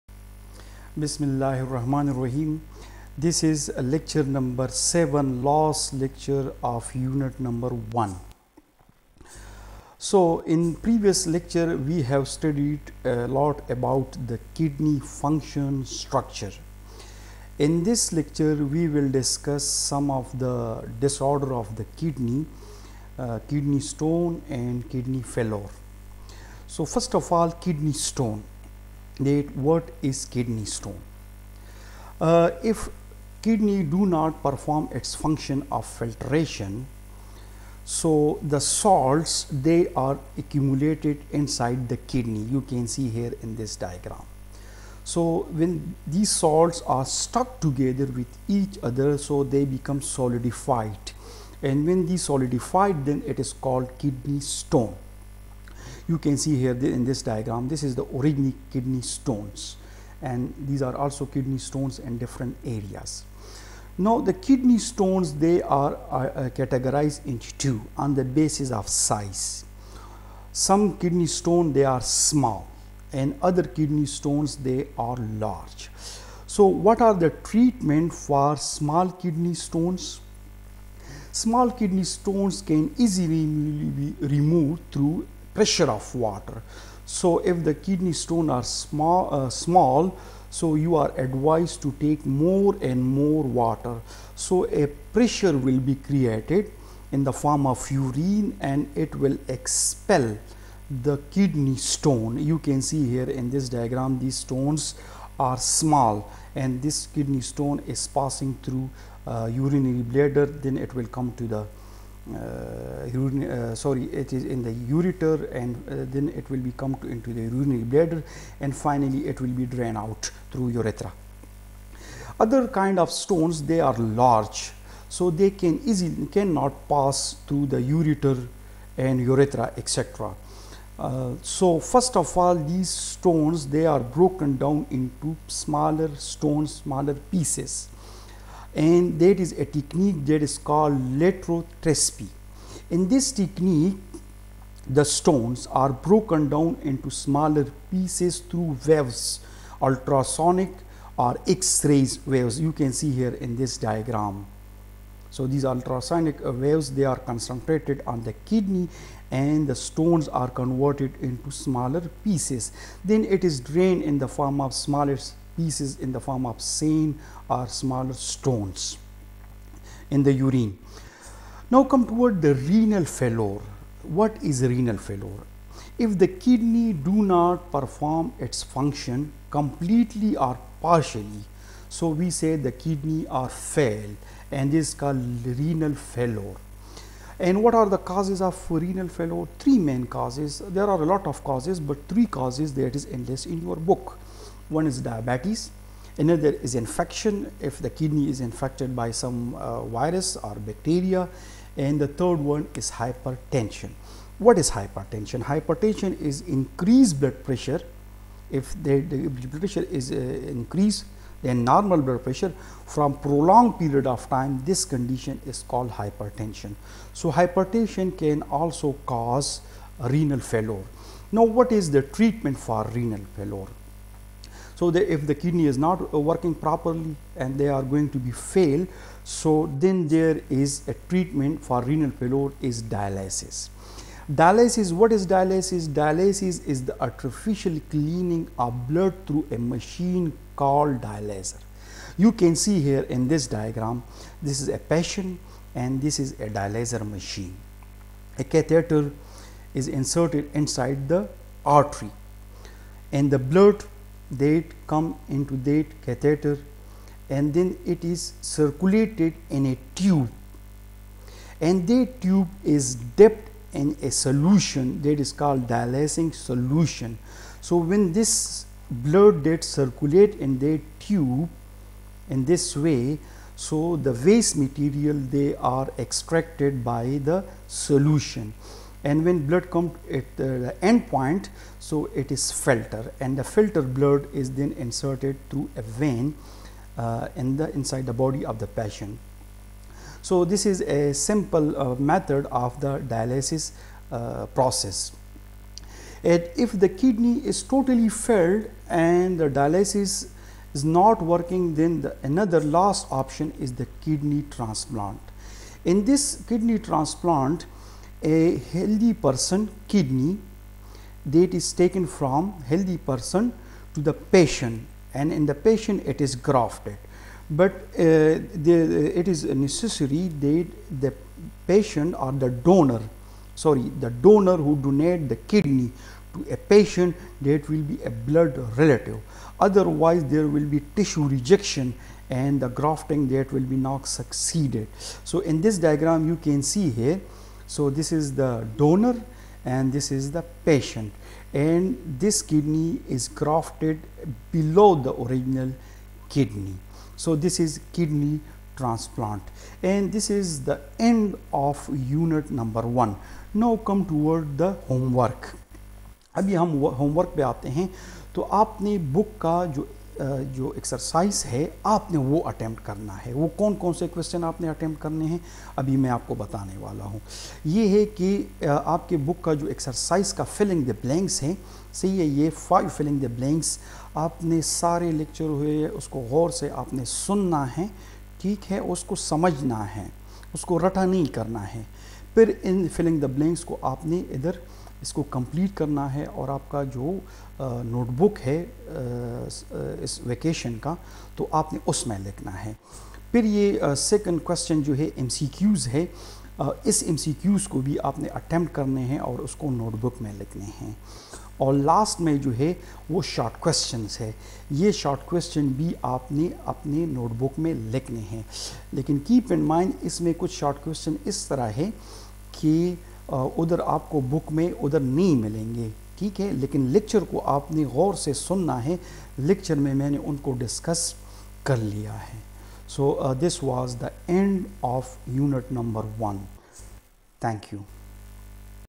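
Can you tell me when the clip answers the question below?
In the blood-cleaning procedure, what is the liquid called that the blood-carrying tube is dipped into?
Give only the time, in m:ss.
4:25.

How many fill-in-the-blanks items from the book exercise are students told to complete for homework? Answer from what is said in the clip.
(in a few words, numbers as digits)
5.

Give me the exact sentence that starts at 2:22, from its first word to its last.
In this technique, the stones are broken down into smaller pieces through waves, ultrasonic or X-rays waves.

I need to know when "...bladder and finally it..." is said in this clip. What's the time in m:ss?
1:57.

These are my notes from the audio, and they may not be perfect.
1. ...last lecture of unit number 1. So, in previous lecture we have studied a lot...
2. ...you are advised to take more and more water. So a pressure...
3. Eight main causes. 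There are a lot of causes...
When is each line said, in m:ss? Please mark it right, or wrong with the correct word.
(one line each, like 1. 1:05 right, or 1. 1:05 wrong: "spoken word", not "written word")
1. 0:05 right
2. 1:30 right
3. 3:09 wrong: "Three", not "Eight".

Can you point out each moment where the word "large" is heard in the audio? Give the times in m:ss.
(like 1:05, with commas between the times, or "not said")
1:15, 2:03.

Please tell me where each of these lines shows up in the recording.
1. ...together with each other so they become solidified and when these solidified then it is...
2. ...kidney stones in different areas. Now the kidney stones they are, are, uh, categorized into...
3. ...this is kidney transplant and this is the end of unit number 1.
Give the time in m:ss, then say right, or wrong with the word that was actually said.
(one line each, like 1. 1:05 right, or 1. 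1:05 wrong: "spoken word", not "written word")
1. 0:47 right
2. 1:01 right
3. 5:47 right.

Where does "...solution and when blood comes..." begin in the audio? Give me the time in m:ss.
4:37.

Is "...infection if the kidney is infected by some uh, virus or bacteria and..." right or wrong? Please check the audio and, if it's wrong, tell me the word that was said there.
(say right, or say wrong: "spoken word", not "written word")
right.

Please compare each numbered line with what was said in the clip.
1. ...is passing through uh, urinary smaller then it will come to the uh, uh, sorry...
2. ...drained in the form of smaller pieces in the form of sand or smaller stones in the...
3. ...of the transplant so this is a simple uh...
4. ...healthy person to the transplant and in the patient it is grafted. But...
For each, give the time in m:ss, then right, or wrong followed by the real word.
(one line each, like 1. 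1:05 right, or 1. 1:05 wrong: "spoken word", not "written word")
1. 1:47 wrong: "bladder", not "smaller"
2. 2:43 right
3. 4:48 wrong: "patient", not "transplant"
4. 5:12 wrong: "patient", not "transplant".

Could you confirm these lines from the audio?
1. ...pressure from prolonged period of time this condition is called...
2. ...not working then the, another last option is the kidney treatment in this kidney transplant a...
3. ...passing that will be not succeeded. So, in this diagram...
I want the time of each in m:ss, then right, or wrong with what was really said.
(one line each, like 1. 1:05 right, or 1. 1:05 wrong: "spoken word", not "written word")
1. 3:32 right
2. 5:00 wrong: "transplant", not "treatment"
3. 5:32 wrong: "grafting", not "passing".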